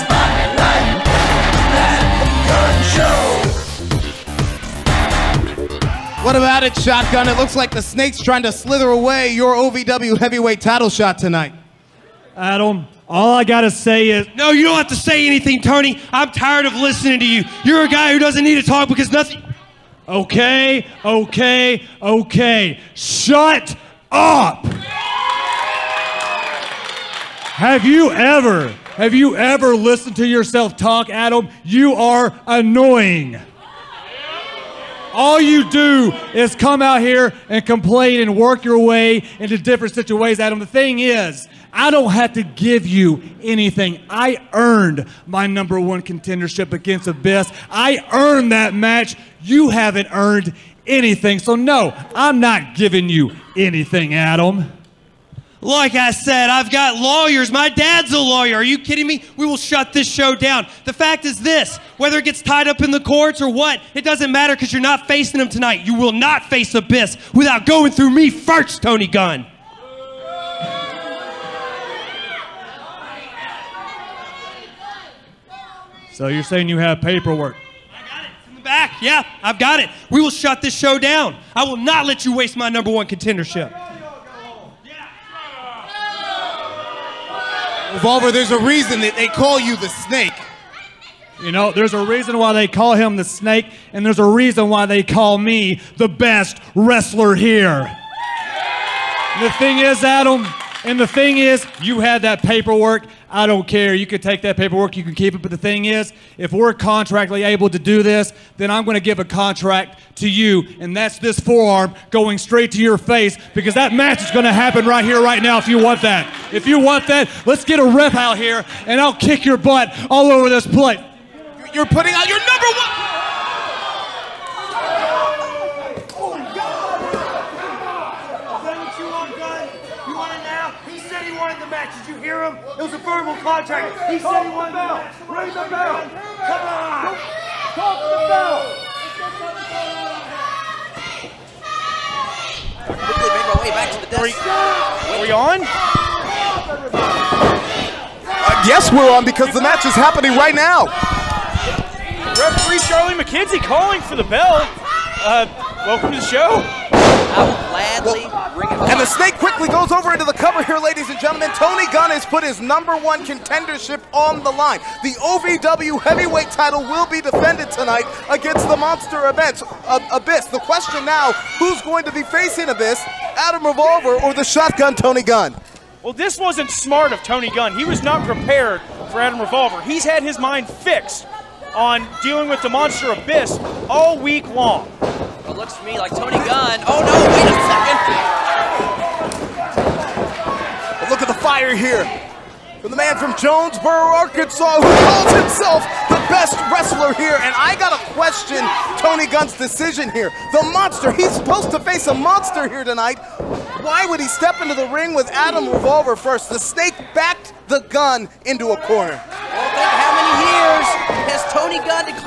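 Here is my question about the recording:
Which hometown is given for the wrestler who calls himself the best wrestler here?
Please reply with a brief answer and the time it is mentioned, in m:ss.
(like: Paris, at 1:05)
Jonesboro, Arkansas, at 3:13.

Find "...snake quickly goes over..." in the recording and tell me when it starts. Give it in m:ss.
2:39.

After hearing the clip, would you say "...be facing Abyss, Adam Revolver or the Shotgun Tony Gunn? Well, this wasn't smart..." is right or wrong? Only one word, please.
right.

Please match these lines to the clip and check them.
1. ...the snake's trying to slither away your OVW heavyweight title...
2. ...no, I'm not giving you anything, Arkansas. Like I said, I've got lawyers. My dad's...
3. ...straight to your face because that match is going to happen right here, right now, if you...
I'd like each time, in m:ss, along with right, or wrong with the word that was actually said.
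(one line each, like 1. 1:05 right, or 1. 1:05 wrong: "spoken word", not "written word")
1. 0:07 right
2. 0:51 wrong: "Adam", not "Arkansas"
3. 1:52 right.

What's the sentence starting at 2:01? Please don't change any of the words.
You're putting out your number one.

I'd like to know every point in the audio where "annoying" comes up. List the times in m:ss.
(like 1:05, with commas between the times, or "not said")
0:32.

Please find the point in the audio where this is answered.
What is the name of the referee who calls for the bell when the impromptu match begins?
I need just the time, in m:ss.
2:32.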